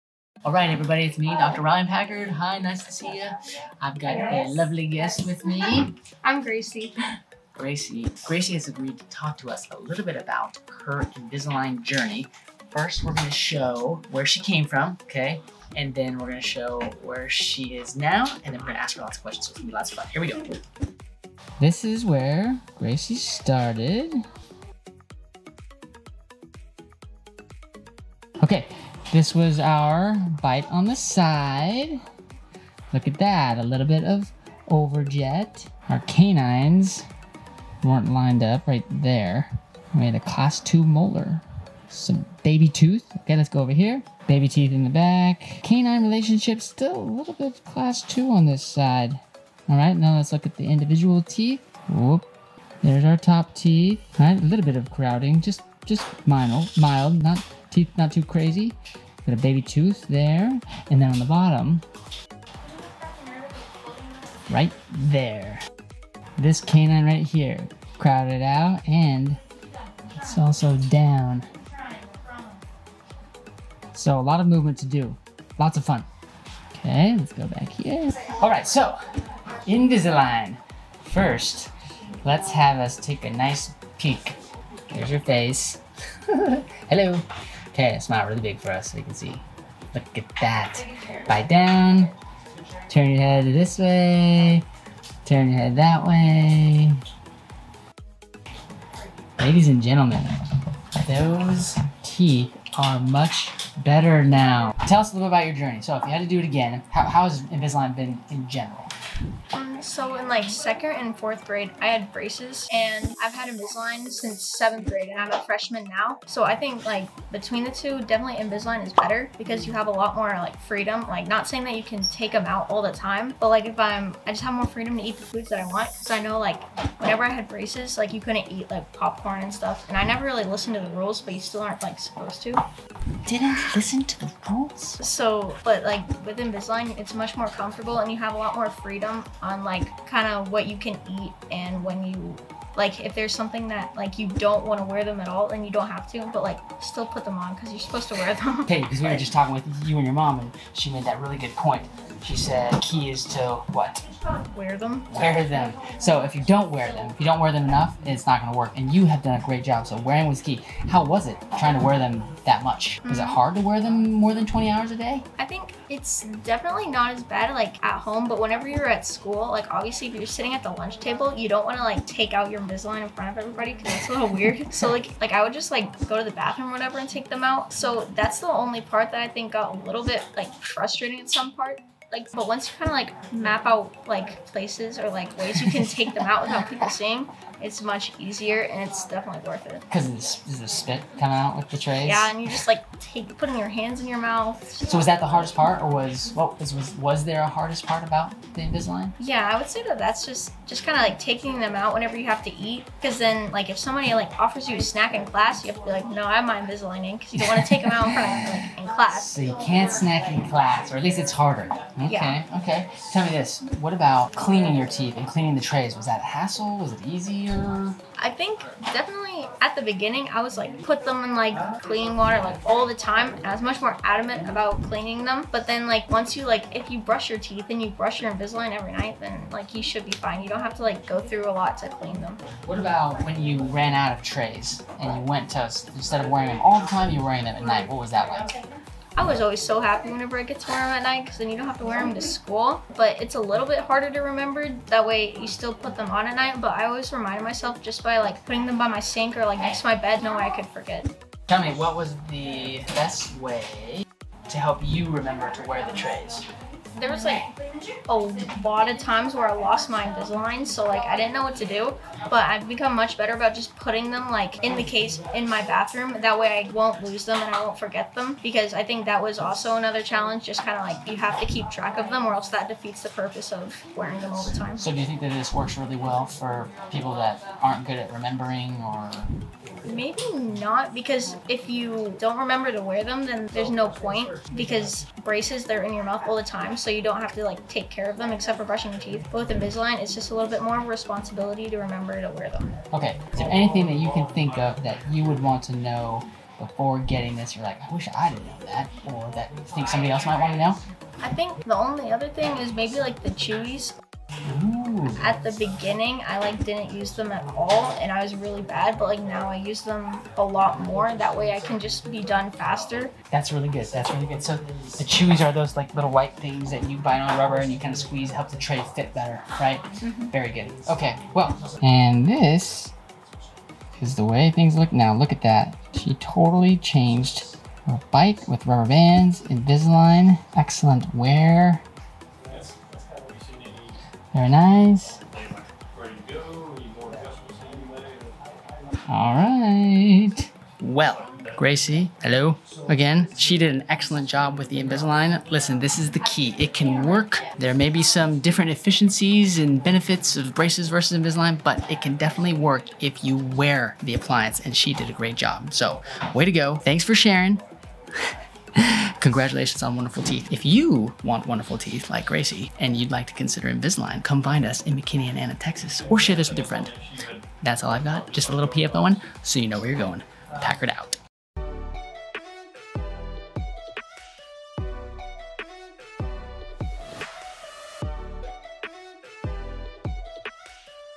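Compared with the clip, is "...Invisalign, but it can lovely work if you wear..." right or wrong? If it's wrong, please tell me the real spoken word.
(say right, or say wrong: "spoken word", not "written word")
wrong: "definitely", not "lovely".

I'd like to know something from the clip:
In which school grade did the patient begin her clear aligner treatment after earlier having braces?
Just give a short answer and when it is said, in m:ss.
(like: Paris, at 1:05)
seventh grade, at 1:54.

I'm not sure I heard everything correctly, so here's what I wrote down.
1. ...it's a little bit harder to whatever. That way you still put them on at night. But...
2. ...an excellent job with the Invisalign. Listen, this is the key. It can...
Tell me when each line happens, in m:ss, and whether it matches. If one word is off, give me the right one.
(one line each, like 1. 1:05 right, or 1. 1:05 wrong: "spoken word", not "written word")
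1. 4:03 wrong: "remember", not "whatever"
2. 5:43 right.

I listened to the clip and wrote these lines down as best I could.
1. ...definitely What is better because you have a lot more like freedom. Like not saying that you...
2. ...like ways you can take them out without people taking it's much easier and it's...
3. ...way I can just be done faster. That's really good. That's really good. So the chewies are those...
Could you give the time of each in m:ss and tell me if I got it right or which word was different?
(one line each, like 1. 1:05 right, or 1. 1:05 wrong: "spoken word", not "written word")
1. 1:58 wrong: "Invisalign", not "What"
2. 3:05 wrong: "seeing", not "taking"
3. 5:11 right.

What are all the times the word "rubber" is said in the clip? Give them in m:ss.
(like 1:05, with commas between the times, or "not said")
5:17, 5:28.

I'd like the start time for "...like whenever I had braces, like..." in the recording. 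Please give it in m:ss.
2:06.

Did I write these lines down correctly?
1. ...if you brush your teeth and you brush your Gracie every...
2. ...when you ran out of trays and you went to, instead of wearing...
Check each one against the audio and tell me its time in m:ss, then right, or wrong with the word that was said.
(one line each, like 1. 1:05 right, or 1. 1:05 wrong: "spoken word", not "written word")
1. 3:46 wrong: "Invisalign", not "Gracie"
2. 3:53 right.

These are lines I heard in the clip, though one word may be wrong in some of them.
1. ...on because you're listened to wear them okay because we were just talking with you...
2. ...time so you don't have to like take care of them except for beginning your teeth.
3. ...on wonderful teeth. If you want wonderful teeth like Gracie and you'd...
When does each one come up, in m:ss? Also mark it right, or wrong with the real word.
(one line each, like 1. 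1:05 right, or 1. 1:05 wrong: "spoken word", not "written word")
1. 2:27 wrong: "supposed", not "listened"
2. 4:46 wrong: "brushing", not "beginning"
3. 5:59 right.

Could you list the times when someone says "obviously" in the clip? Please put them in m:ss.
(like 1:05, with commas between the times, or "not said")
2:49.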